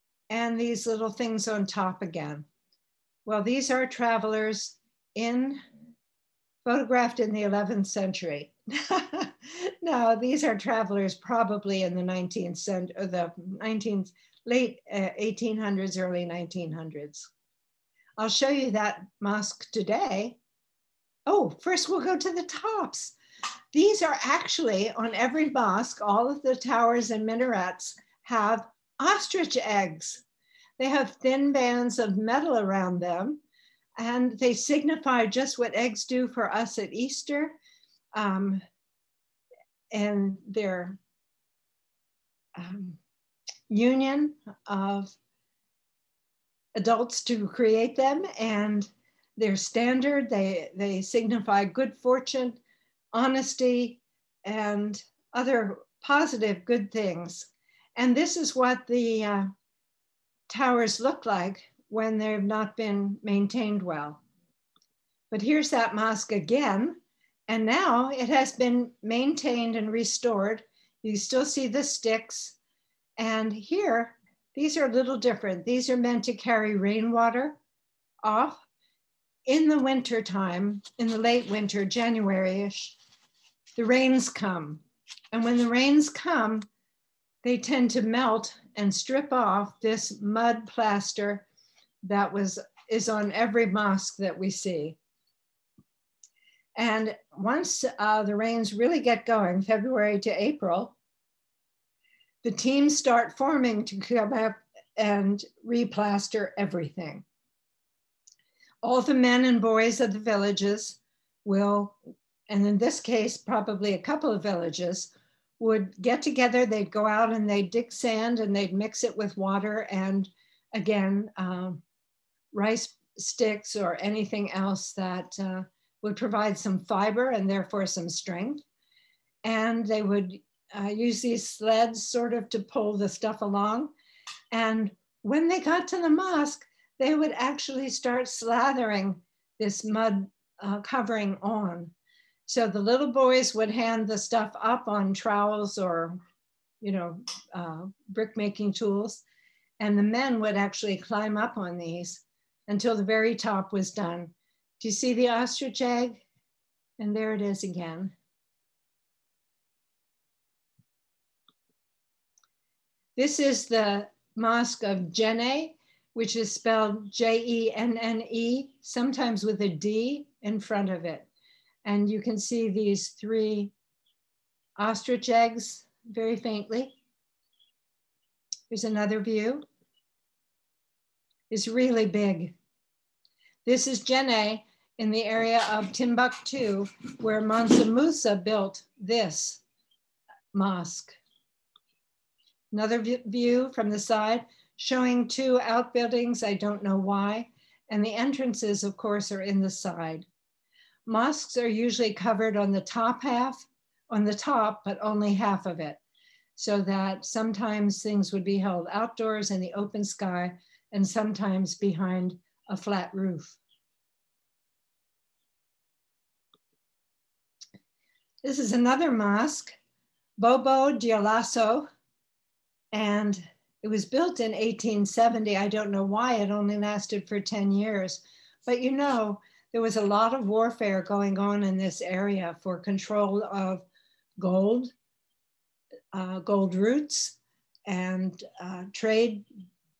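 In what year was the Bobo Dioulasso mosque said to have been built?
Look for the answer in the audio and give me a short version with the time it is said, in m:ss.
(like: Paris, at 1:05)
1870, at 3:44.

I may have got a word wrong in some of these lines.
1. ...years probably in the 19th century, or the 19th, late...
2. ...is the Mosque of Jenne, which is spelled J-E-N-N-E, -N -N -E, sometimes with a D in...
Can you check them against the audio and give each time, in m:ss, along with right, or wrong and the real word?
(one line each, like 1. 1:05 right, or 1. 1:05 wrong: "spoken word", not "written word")
1. 0:10 wrong: "travelers", not "years"
2. 2:43 right.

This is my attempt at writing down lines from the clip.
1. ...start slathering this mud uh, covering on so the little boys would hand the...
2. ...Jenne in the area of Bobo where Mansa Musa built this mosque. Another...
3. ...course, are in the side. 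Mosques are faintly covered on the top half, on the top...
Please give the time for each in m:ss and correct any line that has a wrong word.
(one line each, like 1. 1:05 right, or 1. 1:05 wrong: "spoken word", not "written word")
1. 2:17 right
2. 3:04 wrong: "Timbuktu", not "Bobo"
3. 3:18 wrong: "usually", not "faintly".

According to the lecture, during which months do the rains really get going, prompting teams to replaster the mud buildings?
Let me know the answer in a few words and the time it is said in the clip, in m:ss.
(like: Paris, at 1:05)
February to April, at 1:39.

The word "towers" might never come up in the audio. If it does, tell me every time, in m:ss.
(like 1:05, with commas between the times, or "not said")
0:26, 1:00.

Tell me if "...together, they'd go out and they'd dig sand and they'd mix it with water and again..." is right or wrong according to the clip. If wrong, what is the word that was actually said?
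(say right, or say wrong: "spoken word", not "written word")
right.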